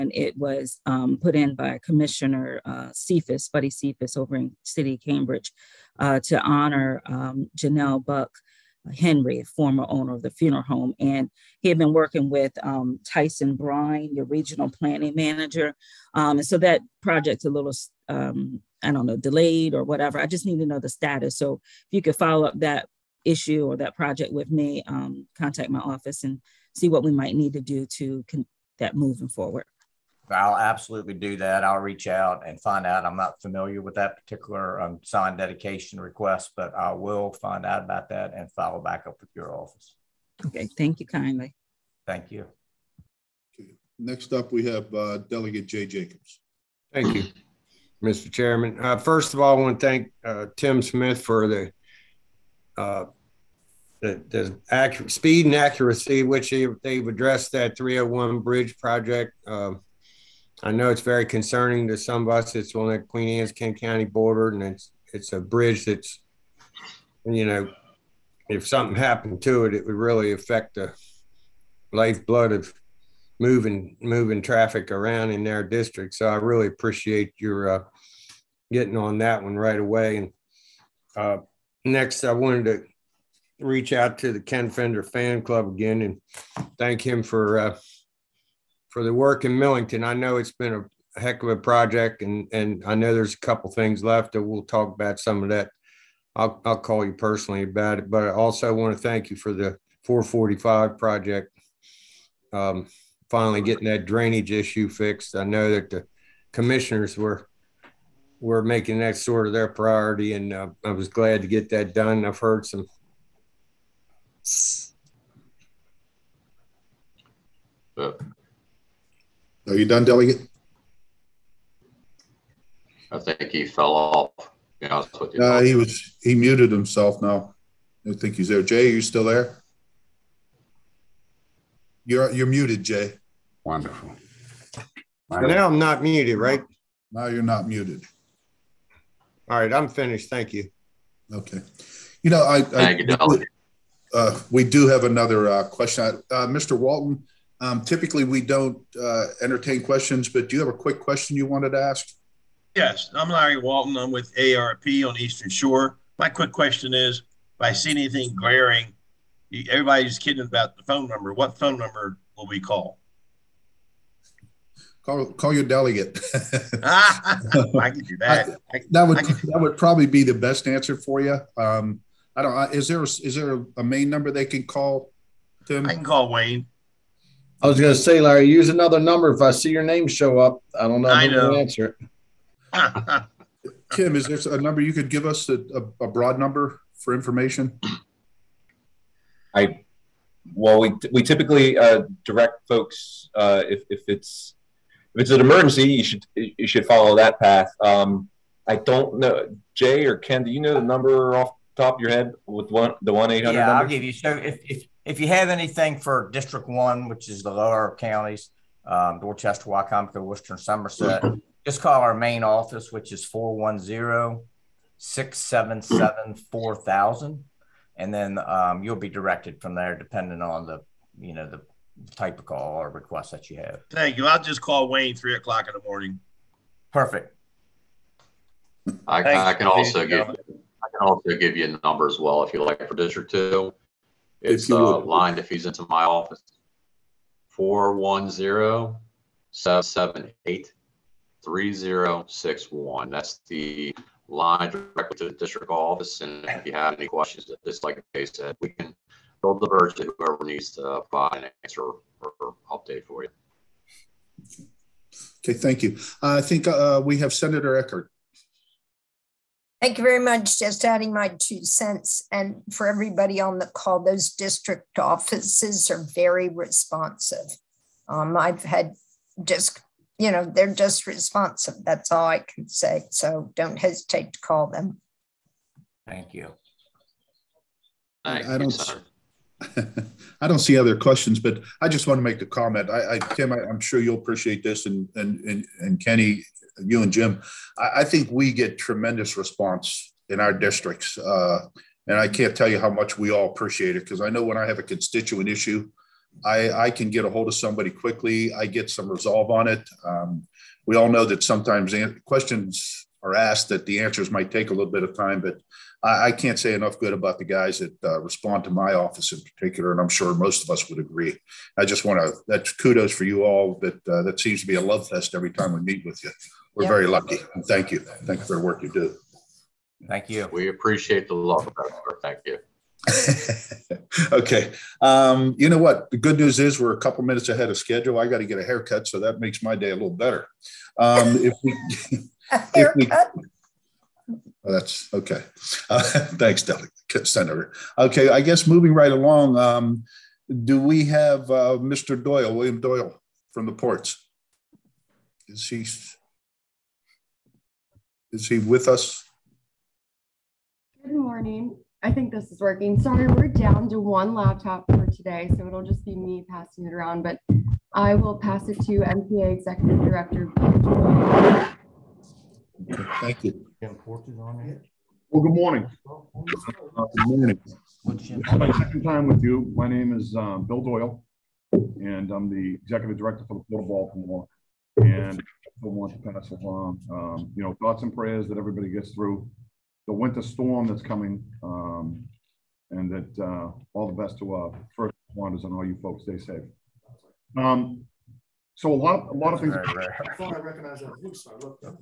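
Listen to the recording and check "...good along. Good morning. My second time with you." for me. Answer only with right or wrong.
wrong.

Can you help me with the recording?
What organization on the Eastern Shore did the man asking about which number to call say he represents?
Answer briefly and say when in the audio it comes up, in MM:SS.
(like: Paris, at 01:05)
AARP, at 02:34.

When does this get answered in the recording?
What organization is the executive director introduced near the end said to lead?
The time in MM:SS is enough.
06:13.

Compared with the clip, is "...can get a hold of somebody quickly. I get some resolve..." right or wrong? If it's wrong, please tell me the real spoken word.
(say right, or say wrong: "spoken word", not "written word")
right.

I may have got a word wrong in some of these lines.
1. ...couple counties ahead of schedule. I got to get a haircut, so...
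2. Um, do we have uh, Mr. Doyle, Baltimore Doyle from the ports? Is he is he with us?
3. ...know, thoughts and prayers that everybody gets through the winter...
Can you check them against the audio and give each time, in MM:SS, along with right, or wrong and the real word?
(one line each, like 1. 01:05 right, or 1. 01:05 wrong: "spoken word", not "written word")
1. 05:26 wrong: "minutes", not "counties"
2. 05:39 wrong: "William", not "Baltimore"
3. 06:17 right.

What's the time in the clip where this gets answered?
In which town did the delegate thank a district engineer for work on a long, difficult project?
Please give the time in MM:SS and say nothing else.
01:29.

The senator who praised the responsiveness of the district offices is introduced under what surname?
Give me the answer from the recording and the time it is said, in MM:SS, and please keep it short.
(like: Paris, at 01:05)
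Eckardt, at 04:17.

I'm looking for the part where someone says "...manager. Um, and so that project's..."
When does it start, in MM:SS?
00:15.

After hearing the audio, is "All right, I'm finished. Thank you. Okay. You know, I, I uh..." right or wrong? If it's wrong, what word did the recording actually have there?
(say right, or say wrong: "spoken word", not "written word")
right.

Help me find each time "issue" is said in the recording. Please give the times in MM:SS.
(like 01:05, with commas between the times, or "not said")
00:23, 01:44, 04:55.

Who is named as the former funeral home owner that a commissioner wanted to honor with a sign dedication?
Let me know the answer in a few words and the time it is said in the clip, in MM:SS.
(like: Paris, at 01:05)
Janelle Buck Henry, at 00:07.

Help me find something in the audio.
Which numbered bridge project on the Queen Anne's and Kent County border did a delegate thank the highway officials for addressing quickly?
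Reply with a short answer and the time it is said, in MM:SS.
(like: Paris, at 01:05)
301, at 00:57.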